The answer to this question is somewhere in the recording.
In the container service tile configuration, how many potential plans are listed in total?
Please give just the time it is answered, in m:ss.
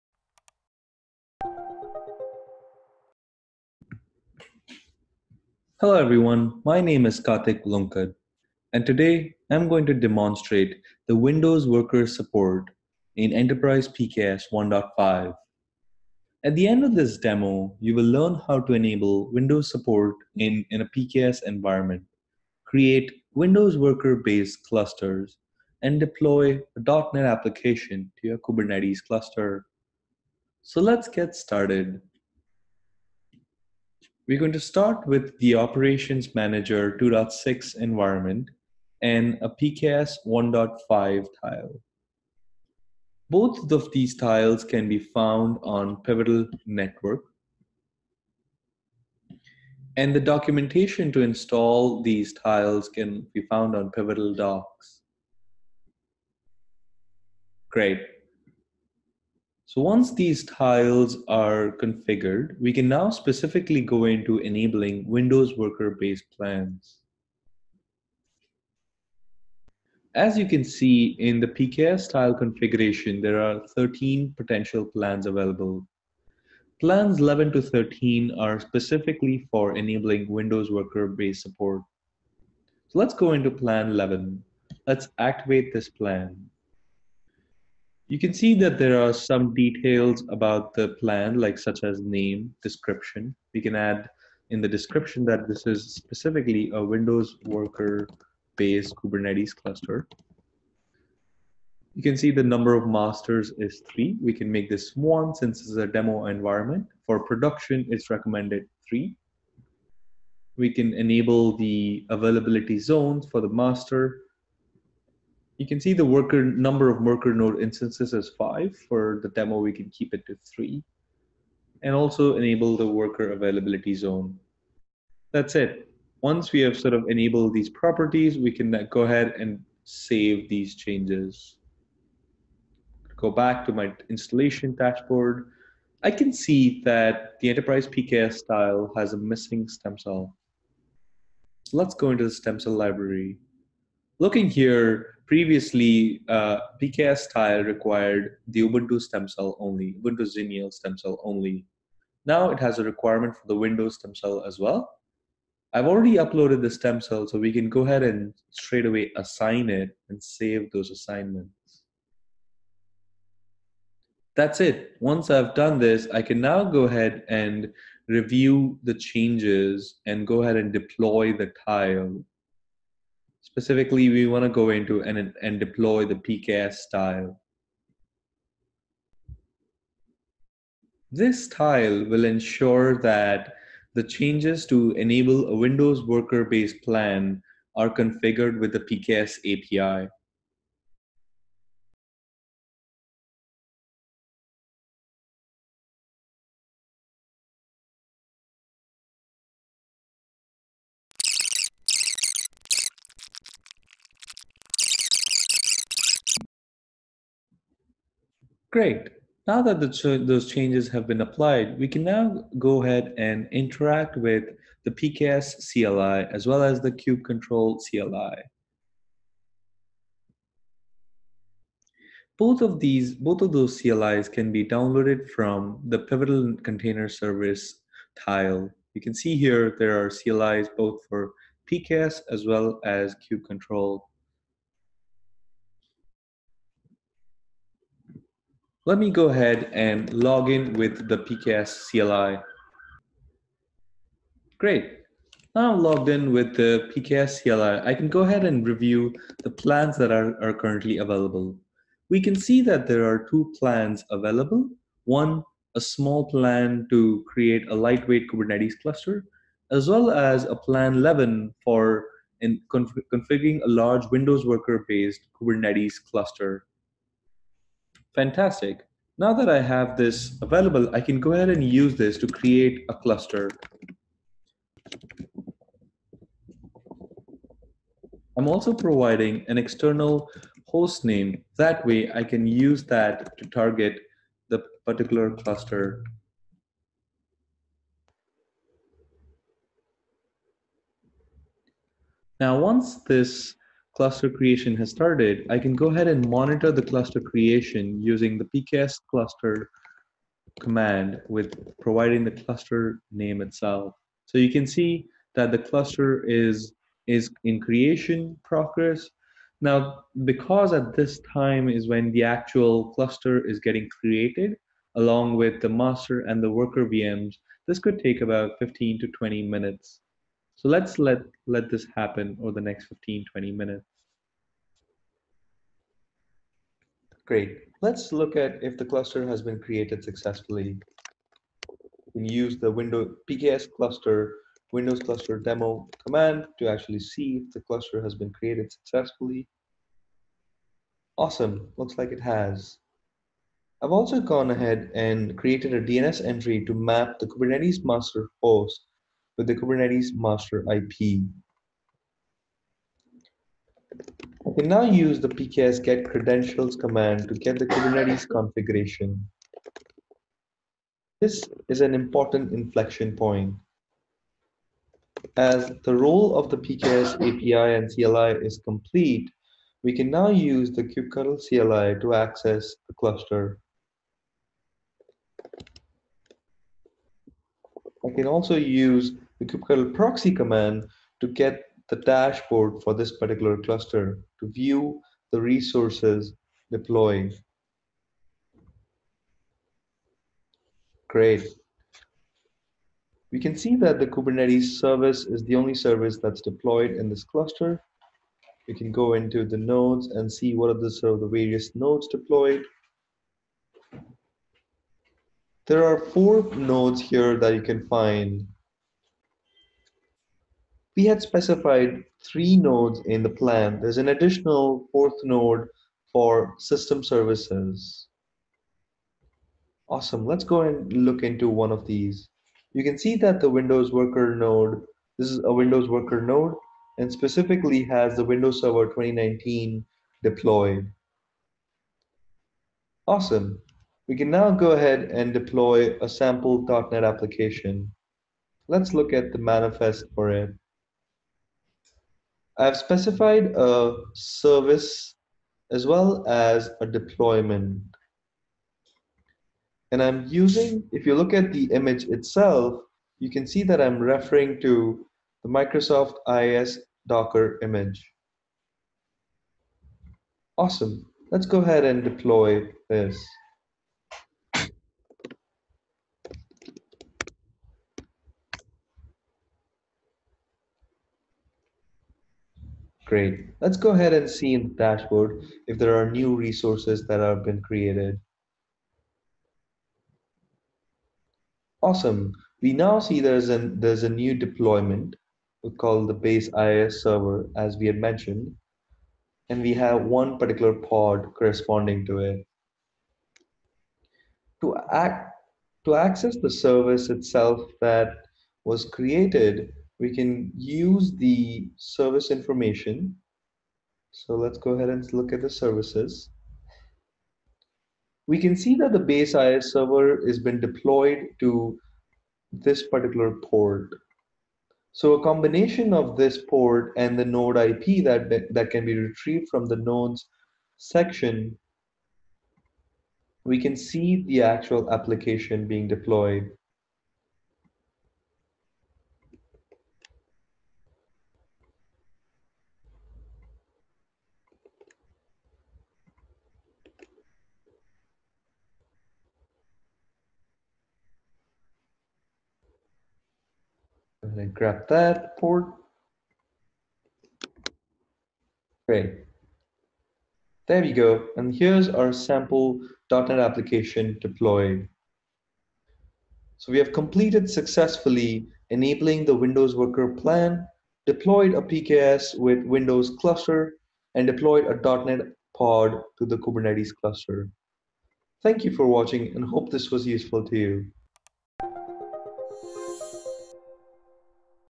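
1:13.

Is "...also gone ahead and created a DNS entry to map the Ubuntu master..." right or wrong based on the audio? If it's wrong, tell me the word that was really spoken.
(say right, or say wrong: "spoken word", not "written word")
wrong: "Kubernetes", not "Ubuntu".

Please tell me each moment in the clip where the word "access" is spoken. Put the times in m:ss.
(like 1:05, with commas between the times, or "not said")
6:12, 8:15.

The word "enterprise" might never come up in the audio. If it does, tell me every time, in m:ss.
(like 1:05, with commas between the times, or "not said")
0:13, 2:17.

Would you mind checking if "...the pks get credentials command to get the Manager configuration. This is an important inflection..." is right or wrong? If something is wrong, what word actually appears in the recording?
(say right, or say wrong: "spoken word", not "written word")
wrong: "Kubernetes", not "Manager".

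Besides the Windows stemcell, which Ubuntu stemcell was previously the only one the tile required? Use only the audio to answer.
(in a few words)
Ubuntu Xenial.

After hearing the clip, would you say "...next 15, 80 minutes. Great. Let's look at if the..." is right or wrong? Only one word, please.
wrong.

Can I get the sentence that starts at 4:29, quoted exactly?
Now that I have this available, I can go ahead and use this to create a cluster.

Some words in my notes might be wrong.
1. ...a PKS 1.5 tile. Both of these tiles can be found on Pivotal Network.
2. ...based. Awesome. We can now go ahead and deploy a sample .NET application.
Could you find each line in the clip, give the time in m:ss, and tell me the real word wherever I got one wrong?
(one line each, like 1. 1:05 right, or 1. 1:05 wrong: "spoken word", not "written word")
1. 0:39 right
2. 7:10 wrong: "deployed", not "based".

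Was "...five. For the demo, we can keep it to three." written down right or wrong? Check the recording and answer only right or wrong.
right.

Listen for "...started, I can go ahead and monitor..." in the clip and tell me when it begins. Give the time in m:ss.
4:54.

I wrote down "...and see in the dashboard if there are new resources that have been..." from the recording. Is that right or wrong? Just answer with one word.
right.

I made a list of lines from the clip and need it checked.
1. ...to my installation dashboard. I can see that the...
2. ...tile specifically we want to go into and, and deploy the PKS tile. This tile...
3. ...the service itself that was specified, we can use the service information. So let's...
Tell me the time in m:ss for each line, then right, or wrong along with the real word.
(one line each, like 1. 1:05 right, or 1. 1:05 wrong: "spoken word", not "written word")
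1. 2:13 right
2. 2:51 right
3. 8:16 wrong: "created", not "specified".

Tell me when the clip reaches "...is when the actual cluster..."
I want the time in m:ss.
5:11.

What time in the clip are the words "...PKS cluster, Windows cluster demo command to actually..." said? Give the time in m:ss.
5:33.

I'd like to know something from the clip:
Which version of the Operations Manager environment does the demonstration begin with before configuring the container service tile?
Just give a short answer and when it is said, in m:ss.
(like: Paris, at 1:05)
2.6, at 0:36.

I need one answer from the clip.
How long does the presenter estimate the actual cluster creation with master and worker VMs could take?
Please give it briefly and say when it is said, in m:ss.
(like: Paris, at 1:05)
15 to 20 minutes, at 5:18.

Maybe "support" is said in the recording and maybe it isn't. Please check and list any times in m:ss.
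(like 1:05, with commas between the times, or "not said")
0:12, 0:19, 1:21.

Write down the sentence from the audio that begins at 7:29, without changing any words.
And I'm using, if you look at the image itself, you can see that I'm referring to the Microsoft IIS Docker image.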